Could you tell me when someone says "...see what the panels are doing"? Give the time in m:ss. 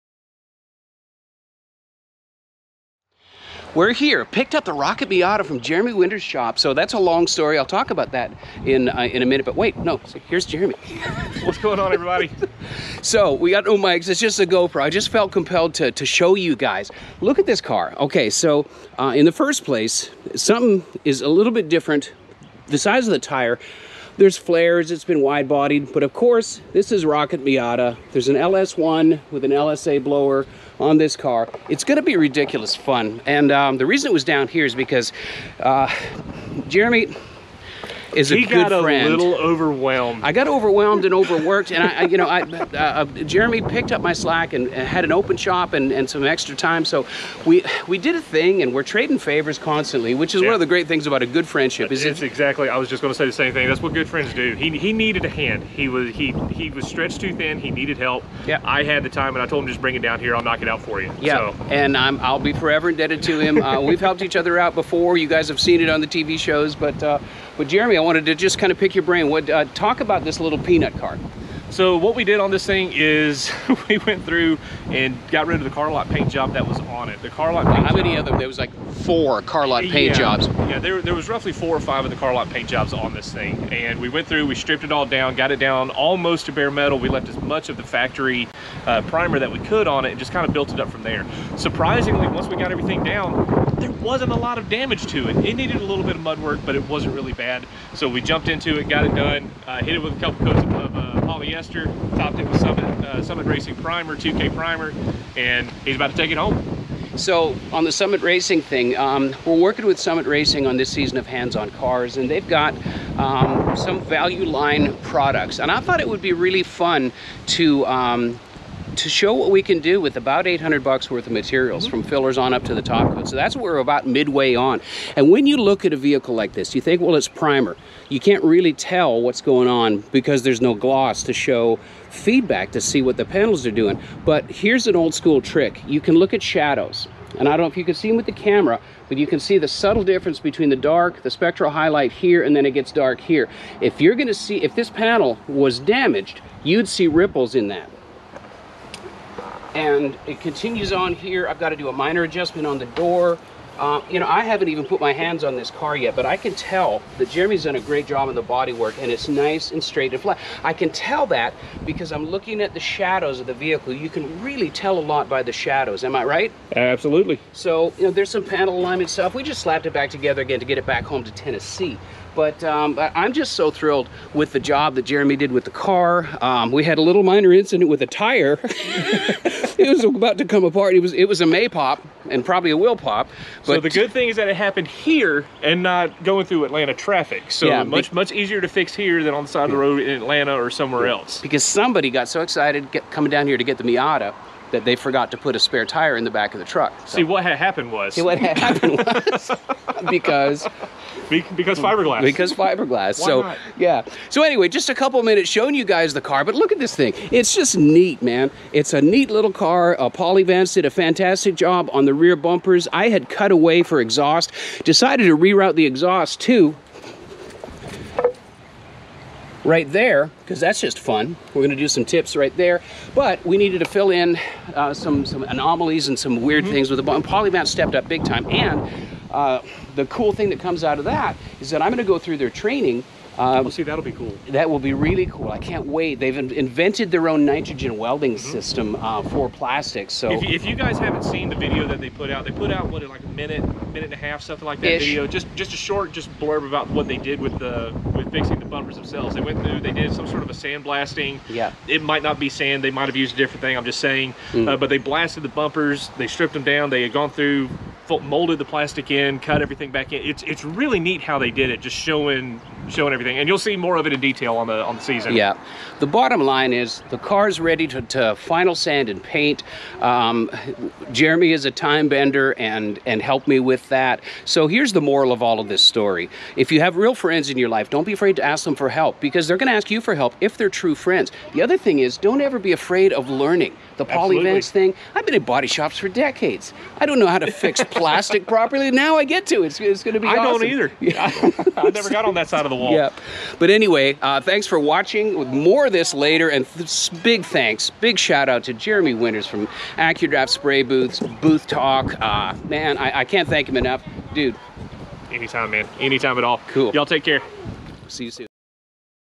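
2:12.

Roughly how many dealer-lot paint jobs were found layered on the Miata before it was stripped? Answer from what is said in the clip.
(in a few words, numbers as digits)
4 or 5.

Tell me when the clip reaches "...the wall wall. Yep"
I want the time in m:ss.
4:52.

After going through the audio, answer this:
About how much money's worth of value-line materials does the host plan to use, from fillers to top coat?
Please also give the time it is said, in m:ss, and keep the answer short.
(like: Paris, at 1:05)
$800, at 2:00.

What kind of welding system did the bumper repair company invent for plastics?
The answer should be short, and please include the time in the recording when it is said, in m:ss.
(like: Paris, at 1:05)
Nitrogen welding, at 3:57.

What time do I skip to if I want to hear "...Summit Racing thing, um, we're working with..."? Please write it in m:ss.
1:47.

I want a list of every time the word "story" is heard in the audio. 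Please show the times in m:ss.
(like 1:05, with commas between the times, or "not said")
0:07, 4:35.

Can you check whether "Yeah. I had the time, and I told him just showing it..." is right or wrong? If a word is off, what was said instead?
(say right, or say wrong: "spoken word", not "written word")
wrong: "bring", not "showing".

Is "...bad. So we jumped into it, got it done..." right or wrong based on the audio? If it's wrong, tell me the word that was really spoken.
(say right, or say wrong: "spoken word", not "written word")
right.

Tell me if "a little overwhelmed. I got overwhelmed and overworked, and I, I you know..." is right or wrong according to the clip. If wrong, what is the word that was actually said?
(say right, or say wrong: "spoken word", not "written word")
right.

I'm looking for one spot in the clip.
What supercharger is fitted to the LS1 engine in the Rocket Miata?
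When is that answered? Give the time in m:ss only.
0:29.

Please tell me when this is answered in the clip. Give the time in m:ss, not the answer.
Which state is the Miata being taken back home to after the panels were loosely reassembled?
2:51.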